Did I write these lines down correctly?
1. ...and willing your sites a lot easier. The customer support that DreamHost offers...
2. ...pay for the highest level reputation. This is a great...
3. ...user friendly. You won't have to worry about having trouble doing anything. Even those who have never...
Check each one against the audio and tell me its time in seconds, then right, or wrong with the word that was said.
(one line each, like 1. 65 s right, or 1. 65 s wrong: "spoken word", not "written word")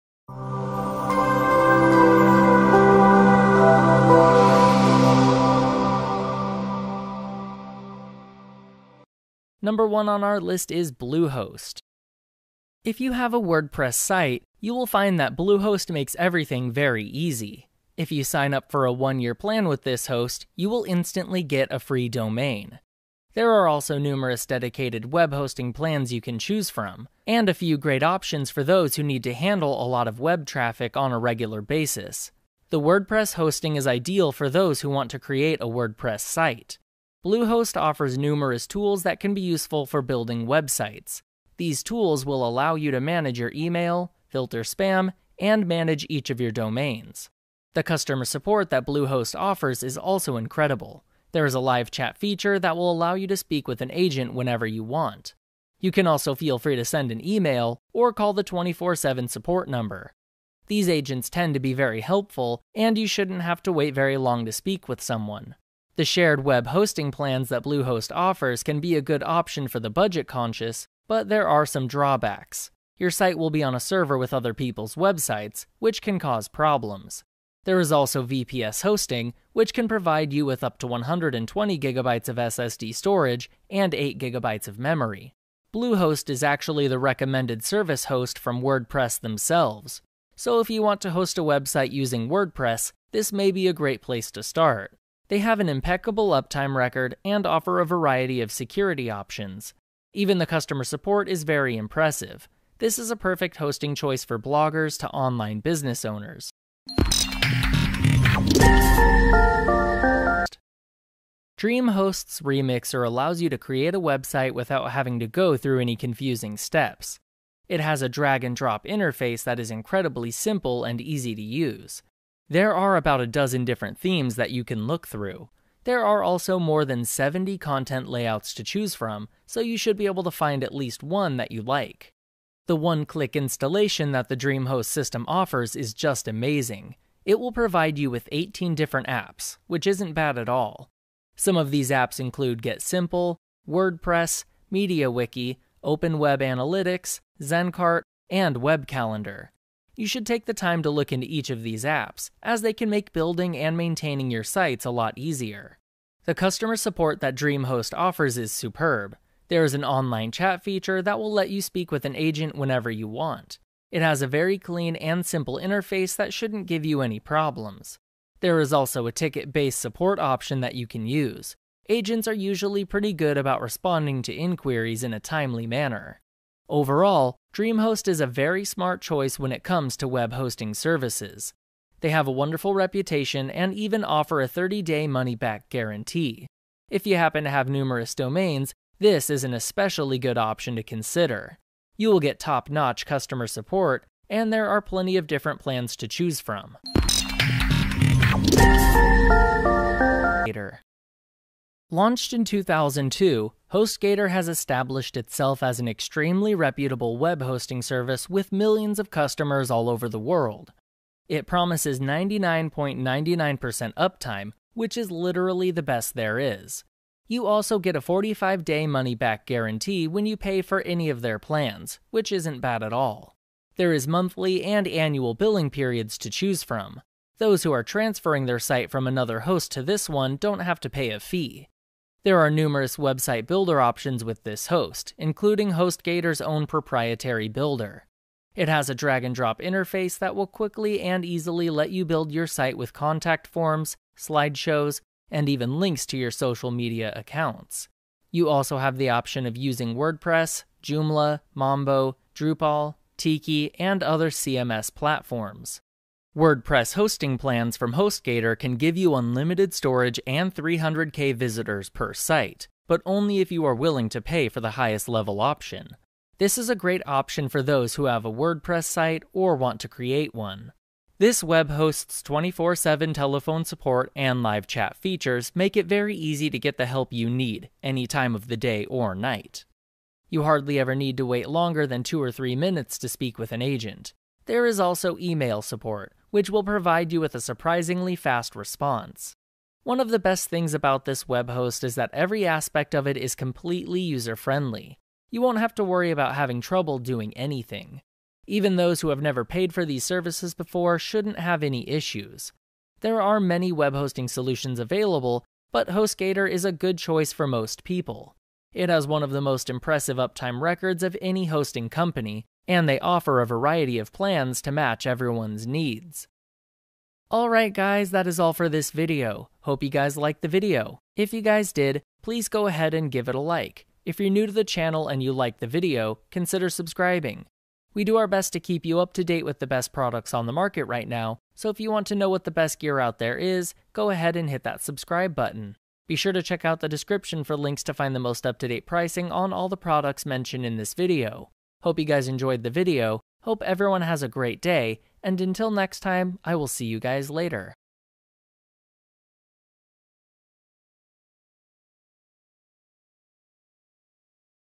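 1. 153 s wrong: "maintaining", not "willing"
2. 264 s wrong: "option", not "reputation"
3. 294 s right.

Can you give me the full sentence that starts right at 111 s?
DreamHost's Remixer allows you to create a website without having to go through any confusing steps.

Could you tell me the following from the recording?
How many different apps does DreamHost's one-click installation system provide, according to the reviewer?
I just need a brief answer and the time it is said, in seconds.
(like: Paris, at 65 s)
18, at 138 s.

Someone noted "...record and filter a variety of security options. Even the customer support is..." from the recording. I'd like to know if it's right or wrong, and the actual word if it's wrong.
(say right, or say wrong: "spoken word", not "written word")
wrong: "offer", not "filter".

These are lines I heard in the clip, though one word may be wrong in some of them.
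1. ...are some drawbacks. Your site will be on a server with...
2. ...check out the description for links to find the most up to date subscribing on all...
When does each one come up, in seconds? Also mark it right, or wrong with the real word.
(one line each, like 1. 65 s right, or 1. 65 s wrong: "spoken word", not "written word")
1. 71 s right
2. 336 s wrong: "pricing", not "subscribing".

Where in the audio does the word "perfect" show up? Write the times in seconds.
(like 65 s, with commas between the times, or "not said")
103 s.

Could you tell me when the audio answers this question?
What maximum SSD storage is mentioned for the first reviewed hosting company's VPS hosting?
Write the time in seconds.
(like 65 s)
80 s.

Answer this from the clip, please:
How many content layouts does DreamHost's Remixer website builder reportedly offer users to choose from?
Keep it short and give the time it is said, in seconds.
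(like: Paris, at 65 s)
more than 70, at 126 s.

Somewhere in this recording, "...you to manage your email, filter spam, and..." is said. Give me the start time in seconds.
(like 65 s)
42 s.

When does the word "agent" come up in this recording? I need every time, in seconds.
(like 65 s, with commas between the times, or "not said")
53 s, 60 s, 162 s, 171 s, 283 s.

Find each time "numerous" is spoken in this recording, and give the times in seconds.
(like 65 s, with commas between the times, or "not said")
23 s, 38 s, 187 s, 232 s.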